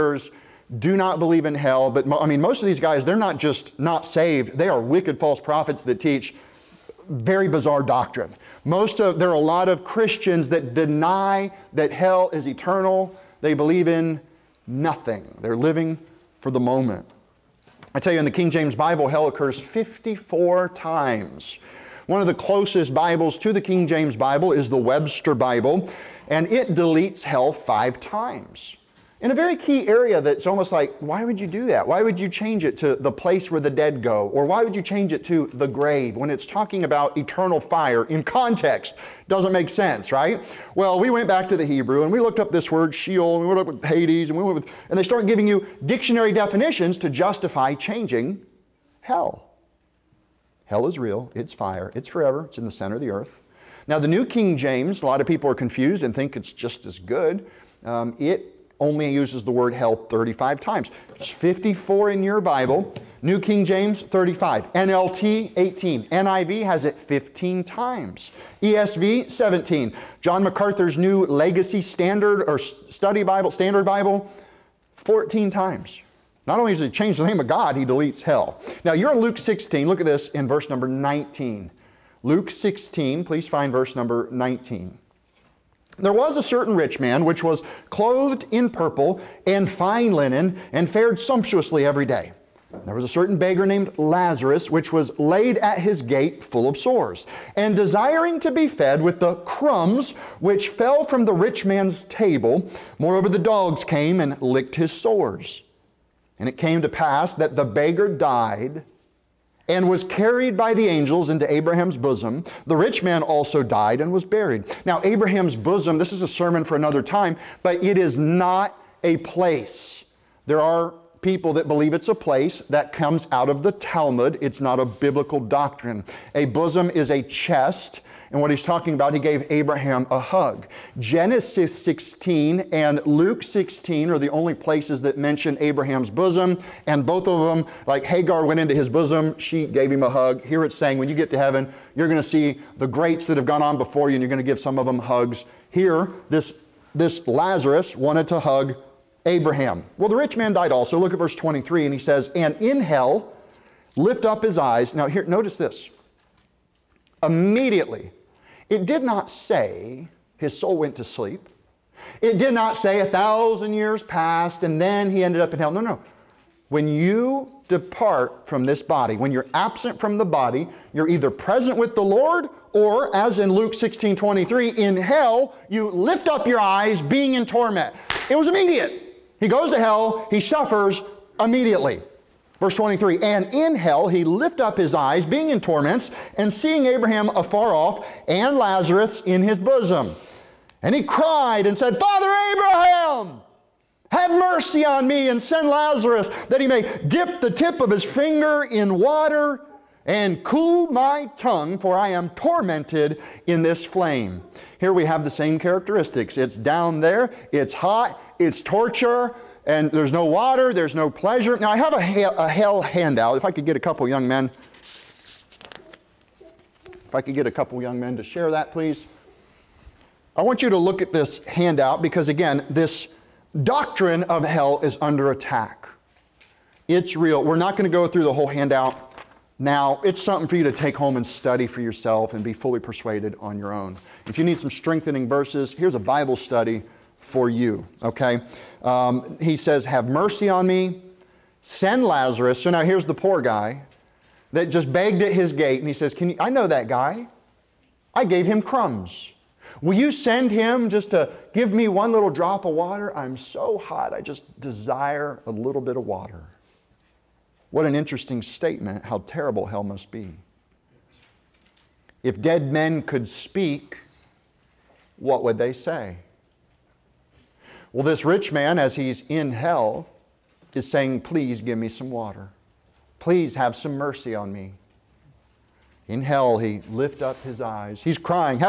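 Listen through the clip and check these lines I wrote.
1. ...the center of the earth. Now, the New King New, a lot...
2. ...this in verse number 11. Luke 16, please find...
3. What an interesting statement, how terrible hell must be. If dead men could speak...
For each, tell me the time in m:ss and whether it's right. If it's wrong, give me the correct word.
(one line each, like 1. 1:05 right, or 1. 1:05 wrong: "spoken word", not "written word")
1. 0:52 wrong: "James", not "New"
2. 1:20 wrong: "19", not "11"
3. 4:17 right.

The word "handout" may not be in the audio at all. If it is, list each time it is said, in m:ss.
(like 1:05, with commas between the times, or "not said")
3:32, 3:41, 3:48.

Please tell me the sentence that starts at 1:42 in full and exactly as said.
Moreover, the dogs came and licked his sores.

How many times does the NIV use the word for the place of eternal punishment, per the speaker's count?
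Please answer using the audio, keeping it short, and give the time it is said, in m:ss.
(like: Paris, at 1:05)
15, at 1:06.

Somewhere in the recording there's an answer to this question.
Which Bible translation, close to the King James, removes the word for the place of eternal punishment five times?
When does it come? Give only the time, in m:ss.
0:24.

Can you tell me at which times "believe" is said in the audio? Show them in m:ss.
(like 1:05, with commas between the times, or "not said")
0:01, 0:13, 2:01.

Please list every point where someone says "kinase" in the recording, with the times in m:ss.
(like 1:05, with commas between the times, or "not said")
not said.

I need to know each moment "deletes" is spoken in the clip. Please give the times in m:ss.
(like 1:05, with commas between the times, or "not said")
0:26, 1:17.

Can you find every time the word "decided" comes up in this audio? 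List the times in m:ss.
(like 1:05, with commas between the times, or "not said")
not said.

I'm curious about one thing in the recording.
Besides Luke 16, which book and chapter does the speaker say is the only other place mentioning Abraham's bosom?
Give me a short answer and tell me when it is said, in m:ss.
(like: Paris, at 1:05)
Genesis 16, at 2:10.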